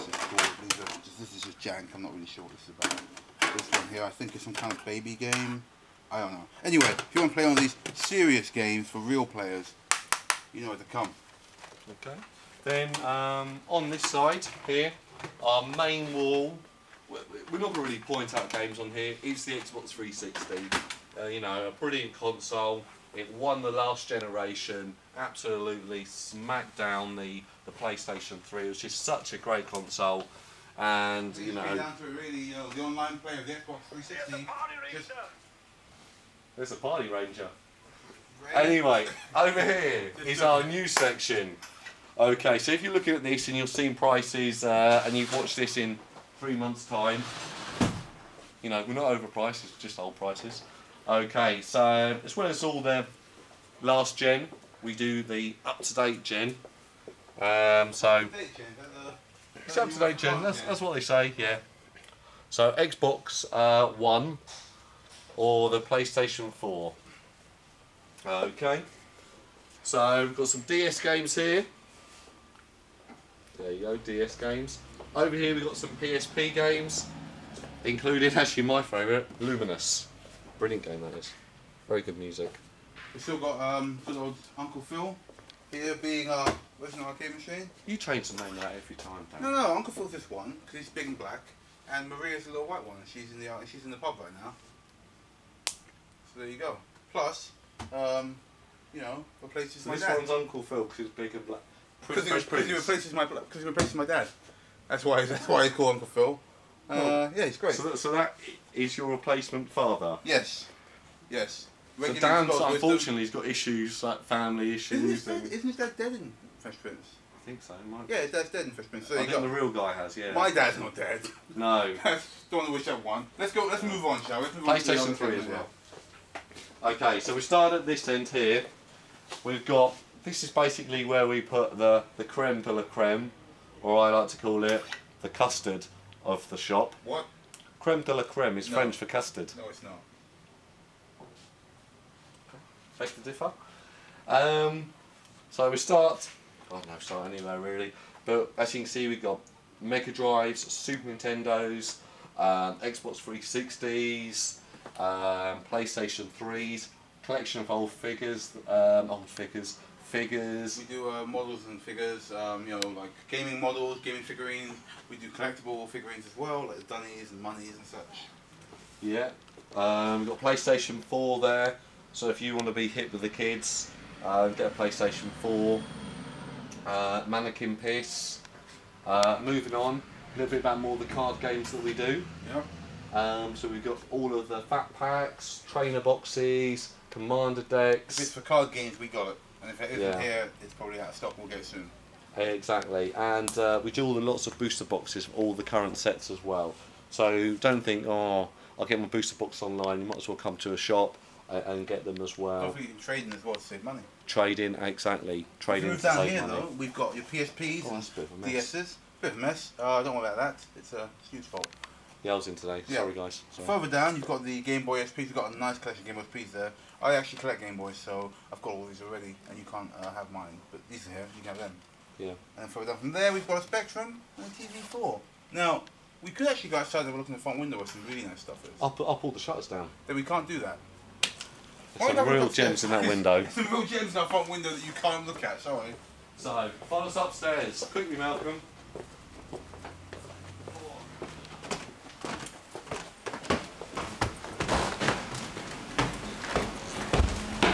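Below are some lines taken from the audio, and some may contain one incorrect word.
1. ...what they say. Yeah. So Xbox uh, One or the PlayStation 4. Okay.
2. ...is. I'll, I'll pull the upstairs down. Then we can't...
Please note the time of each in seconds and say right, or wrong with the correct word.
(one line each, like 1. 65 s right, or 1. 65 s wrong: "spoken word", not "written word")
1. 60 s right
2. 228 s wrong: "shutters", not "upstairs".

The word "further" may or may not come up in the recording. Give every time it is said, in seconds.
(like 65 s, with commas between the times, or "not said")
213 s, 222 s.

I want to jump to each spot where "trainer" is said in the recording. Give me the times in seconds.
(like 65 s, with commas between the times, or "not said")
185 s.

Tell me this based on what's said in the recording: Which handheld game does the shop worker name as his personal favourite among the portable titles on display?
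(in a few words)
Lumines.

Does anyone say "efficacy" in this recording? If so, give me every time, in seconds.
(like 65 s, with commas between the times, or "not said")
not said.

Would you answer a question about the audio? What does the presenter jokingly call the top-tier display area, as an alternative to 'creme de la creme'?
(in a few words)
the custard of the shop.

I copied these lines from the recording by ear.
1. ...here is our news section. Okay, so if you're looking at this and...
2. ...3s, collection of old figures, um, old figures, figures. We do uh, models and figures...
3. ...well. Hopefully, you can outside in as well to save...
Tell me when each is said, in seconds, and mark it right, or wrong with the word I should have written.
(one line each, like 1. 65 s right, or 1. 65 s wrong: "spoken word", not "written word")
1. 39 s right
2. 156 s right
3. 202 s wrong: "trade", not "outside".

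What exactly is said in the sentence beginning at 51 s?
Okay, so as well as all the last gen, we do the up-to-date gen.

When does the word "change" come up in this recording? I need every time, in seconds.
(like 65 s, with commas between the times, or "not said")
87 s.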